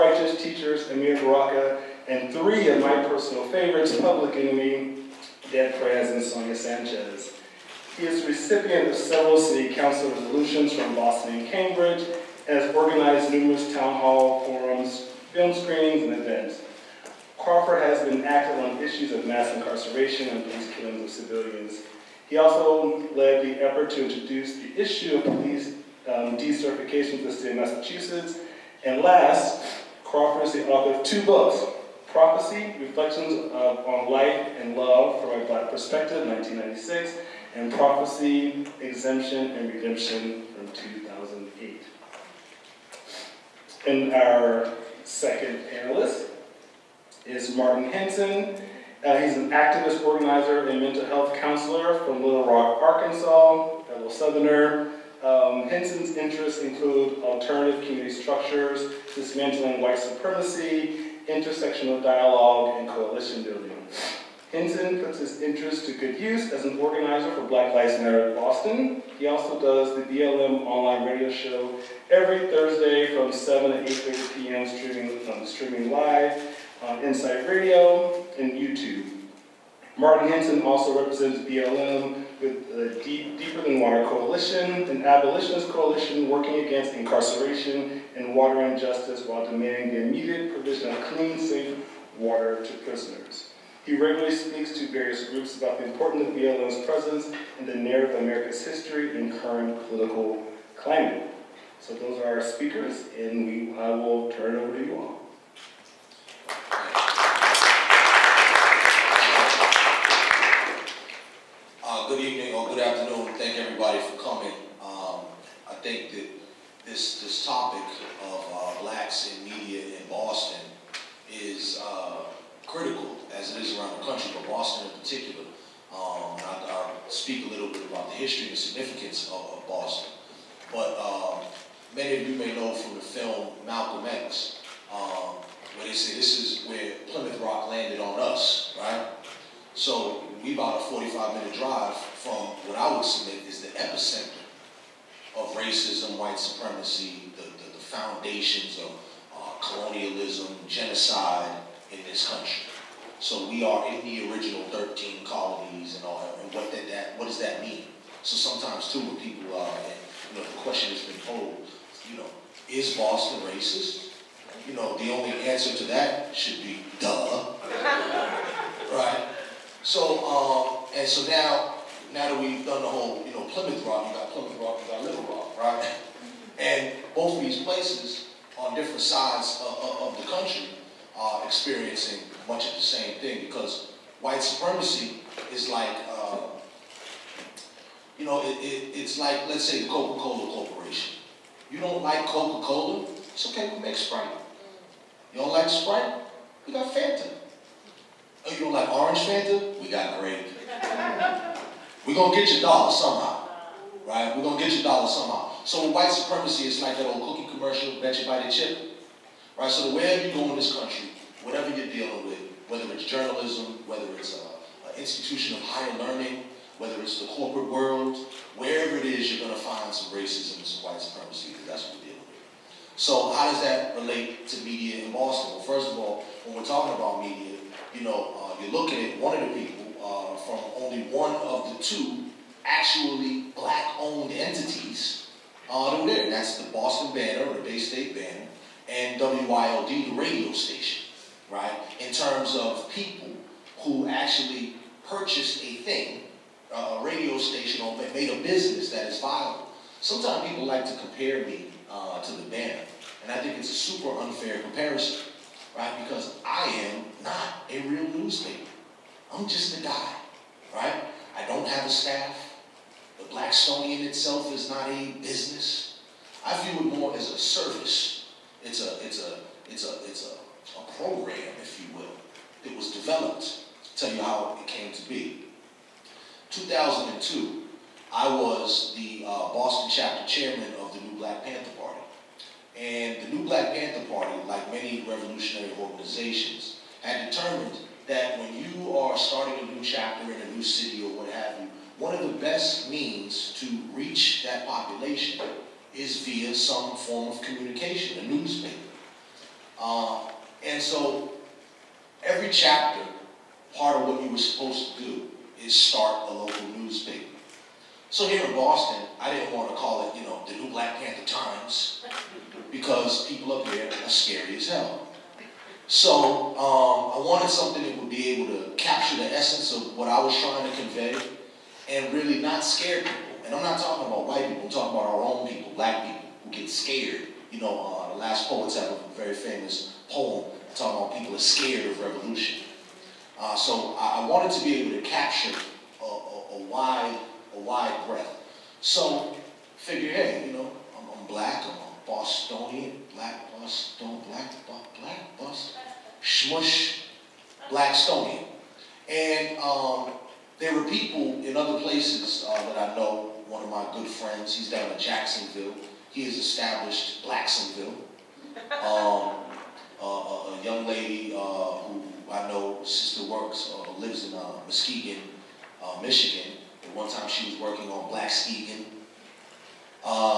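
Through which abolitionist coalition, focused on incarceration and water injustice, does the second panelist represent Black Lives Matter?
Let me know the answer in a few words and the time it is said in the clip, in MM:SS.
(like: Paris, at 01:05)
Deeper Than Water Coalition, at 01:23.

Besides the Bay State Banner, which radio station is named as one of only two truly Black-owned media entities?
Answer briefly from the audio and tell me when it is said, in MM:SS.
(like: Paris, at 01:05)
WYLD, at 03:59.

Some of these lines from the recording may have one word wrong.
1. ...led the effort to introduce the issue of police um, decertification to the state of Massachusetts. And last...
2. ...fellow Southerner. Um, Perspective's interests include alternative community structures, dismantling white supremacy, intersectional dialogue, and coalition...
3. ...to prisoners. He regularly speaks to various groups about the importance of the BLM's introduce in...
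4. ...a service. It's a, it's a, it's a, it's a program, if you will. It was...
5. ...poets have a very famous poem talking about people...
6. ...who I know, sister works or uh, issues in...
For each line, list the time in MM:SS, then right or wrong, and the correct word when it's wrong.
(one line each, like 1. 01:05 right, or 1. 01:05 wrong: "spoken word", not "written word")
1. 00:23 right
2. 00:53 wrong: "Henson", not "Perspective"
3. 01:32 wrong: "presence", not "introduce"
4. 04:27 right
5. 05:28 right
6. 06:01 wrong: "lives", not "issues".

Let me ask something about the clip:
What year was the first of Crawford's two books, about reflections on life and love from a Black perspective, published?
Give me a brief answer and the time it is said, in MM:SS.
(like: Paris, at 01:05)
1996, at 00:36.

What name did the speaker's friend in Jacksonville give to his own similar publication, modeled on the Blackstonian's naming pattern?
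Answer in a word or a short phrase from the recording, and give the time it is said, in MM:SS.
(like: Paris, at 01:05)
Blacksonville, at 05:57.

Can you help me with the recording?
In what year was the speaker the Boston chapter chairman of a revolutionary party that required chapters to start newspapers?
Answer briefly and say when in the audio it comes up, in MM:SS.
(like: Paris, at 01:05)
2002, at 04:36.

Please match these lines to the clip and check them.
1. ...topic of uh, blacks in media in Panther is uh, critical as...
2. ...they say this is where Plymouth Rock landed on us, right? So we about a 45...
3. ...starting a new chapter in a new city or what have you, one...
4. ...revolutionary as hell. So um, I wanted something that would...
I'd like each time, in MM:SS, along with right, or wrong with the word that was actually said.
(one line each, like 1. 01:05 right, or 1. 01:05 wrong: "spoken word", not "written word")
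1. 01:57 wrong: "Boston", not "Panther"
2. 02:15 right
3. 04:49 right
4. 05:14 wrong: "scary", not "revolutionary".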